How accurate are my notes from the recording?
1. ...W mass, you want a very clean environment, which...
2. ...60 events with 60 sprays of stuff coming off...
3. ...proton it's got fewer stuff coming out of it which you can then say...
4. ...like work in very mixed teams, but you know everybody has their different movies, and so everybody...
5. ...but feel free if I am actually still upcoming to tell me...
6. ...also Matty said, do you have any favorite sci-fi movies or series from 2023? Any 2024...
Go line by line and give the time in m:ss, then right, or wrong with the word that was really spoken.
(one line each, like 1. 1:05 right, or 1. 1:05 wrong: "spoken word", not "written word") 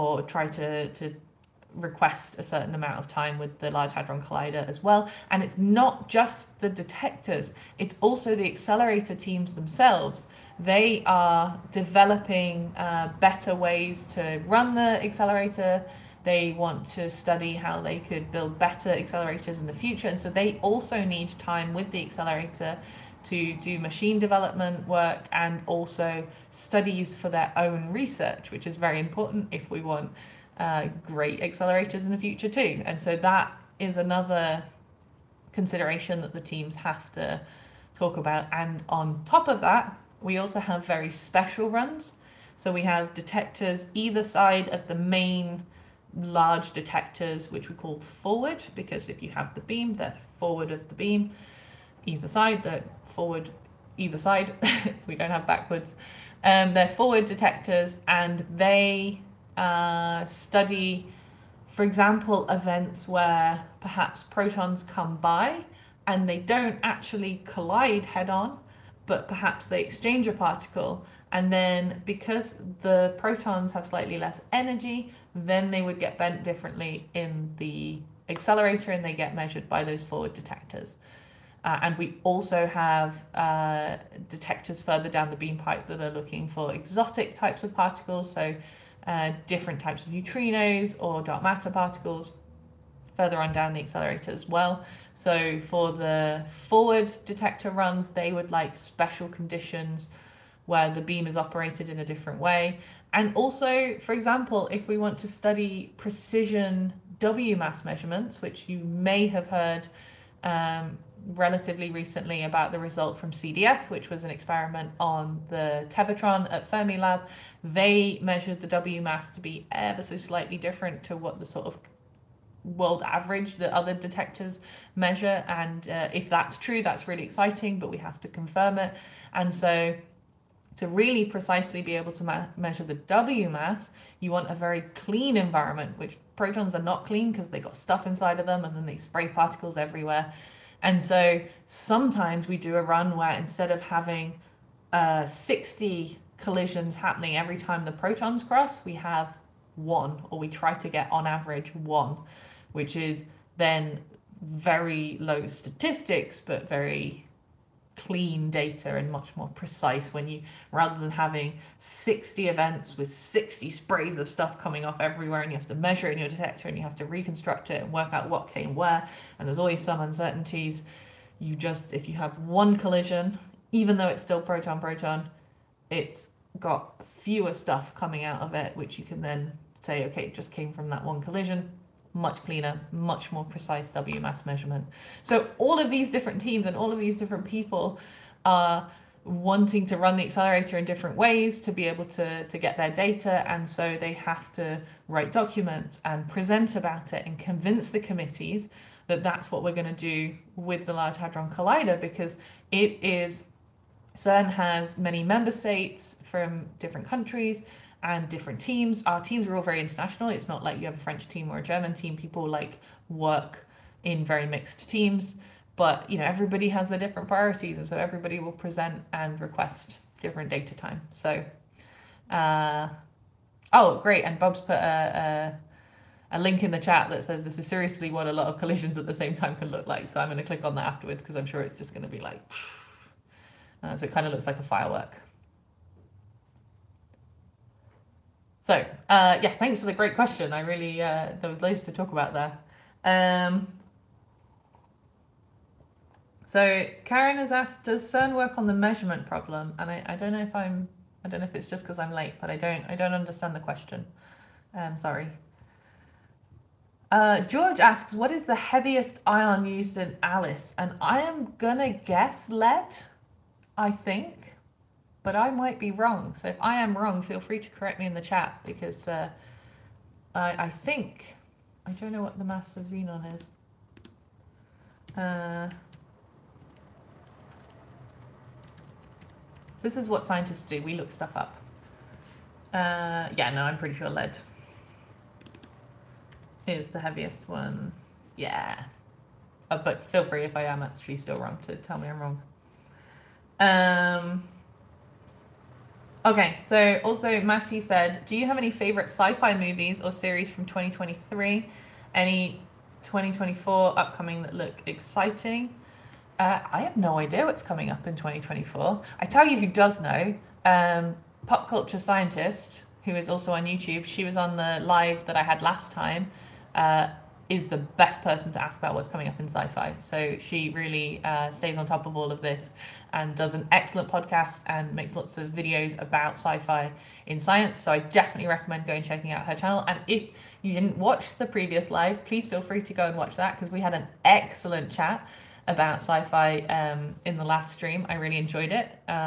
1. 2:12 right
2. 2:41 right
3. 2:54 right
4. 3:32 wrong: "priorities", not "movies"
5. 4:49 wrong: "wrong", not "upcoming"
6. 4:57 right.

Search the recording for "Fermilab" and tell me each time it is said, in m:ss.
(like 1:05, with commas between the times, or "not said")
1:56.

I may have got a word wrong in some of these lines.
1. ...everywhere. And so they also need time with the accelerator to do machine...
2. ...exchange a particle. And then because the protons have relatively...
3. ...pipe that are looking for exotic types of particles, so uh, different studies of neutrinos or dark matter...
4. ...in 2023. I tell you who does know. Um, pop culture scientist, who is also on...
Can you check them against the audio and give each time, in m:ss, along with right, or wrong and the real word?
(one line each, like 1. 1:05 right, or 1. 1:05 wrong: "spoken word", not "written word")
1. 0:19 wrong: "future", not "everywhere"
2. 1:09 wrong: "slightly", not "relatively"
3. 1:25 wrong: "types", not "studies"
4. 5:08 wrong: "2024", not "2023".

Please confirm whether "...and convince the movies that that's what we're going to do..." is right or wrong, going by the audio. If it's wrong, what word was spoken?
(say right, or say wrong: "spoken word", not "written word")
wrong: "committees", not "movies".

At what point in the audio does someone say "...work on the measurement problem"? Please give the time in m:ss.
4:08.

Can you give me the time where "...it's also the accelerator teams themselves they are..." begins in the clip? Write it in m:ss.
0:07.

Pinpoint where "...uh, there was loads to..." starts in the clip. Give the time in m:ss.
4:01.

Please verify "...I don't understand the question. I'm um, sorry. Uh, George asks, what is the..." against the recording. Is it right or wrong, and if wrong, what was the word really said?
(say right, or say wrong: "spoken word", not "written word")
right.